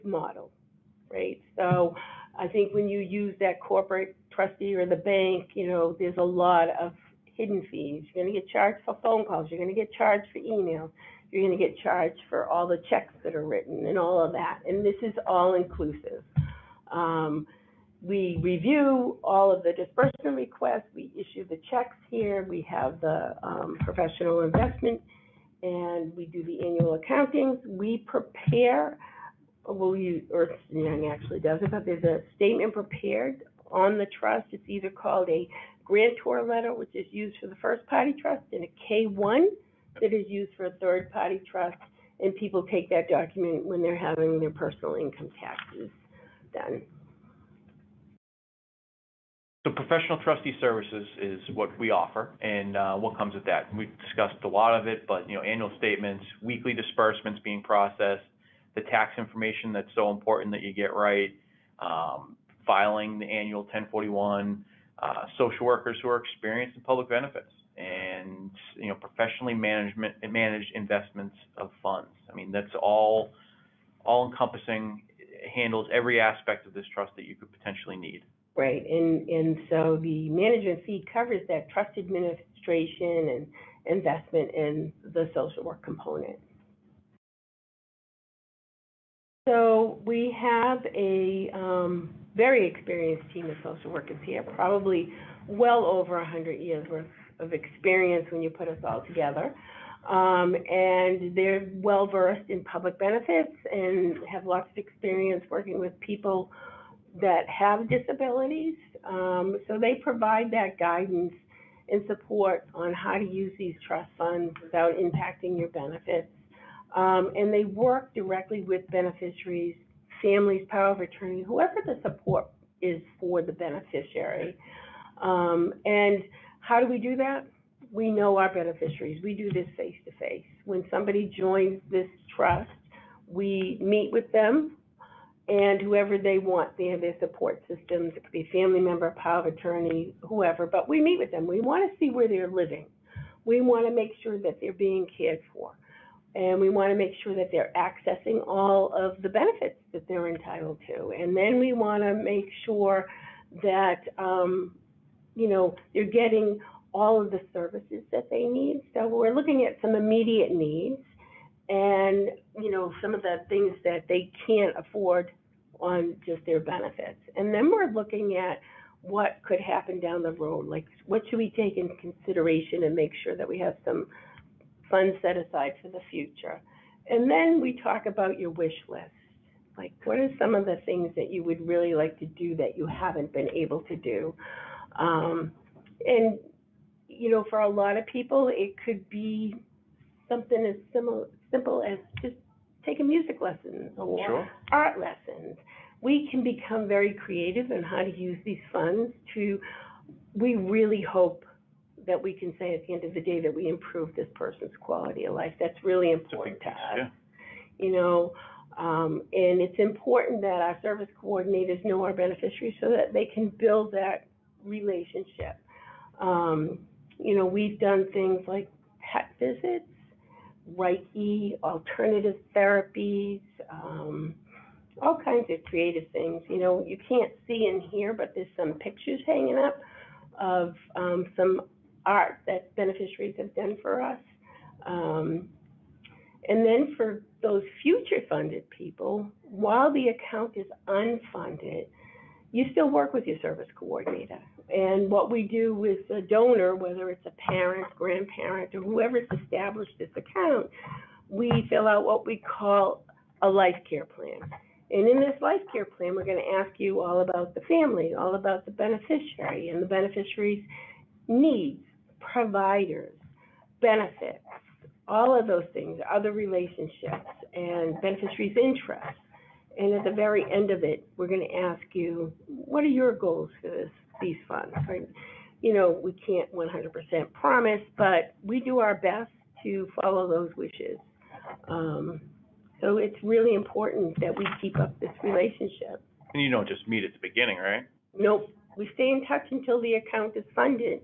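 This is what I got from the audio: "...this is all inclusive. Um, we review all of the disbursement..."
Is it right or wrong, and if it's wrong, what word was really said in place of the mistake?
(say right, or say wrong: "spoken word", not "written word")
right.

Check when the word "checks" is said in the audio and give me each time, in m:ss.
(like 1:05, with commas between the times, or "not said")
0:12, 0:21.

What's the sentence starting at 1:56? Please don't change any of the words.
Um, and they work directly with beneficiaries, families, power of attorney, whoever the support is for the beneficiary.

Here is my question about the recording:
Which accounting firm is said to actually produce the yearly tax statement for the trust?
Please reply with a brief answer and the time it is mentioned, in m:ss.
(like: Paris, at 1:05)
Ernst Young, at 0:30.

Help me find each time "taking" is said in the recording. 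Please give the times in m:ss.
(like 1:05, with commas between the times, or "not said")
3:12.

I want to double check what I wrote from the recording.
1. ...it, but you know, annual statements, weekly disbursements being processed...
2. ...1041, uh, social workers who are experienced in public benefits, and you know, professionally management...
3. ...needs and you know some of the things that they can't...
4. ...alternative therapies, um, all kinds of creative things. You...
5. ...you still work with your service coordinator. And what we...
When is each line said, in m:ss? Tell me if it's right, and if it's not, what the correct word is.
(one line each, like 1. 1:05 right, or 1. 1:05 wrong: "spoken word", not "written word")
1. 0:54 right
2. 1:03 right
3. 2:40 right
4. 3:41 right
5. 4:02 right.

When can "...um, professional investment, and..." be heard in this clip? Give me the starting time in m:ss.
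0:23.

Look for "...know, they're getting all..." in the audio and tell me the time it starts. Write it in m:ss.
2:35.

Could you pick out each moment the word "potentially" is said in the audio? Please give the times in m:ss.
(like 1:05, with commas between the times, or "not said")
1:17.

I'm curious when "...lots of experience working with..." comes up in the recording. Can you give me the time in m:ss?
1:44.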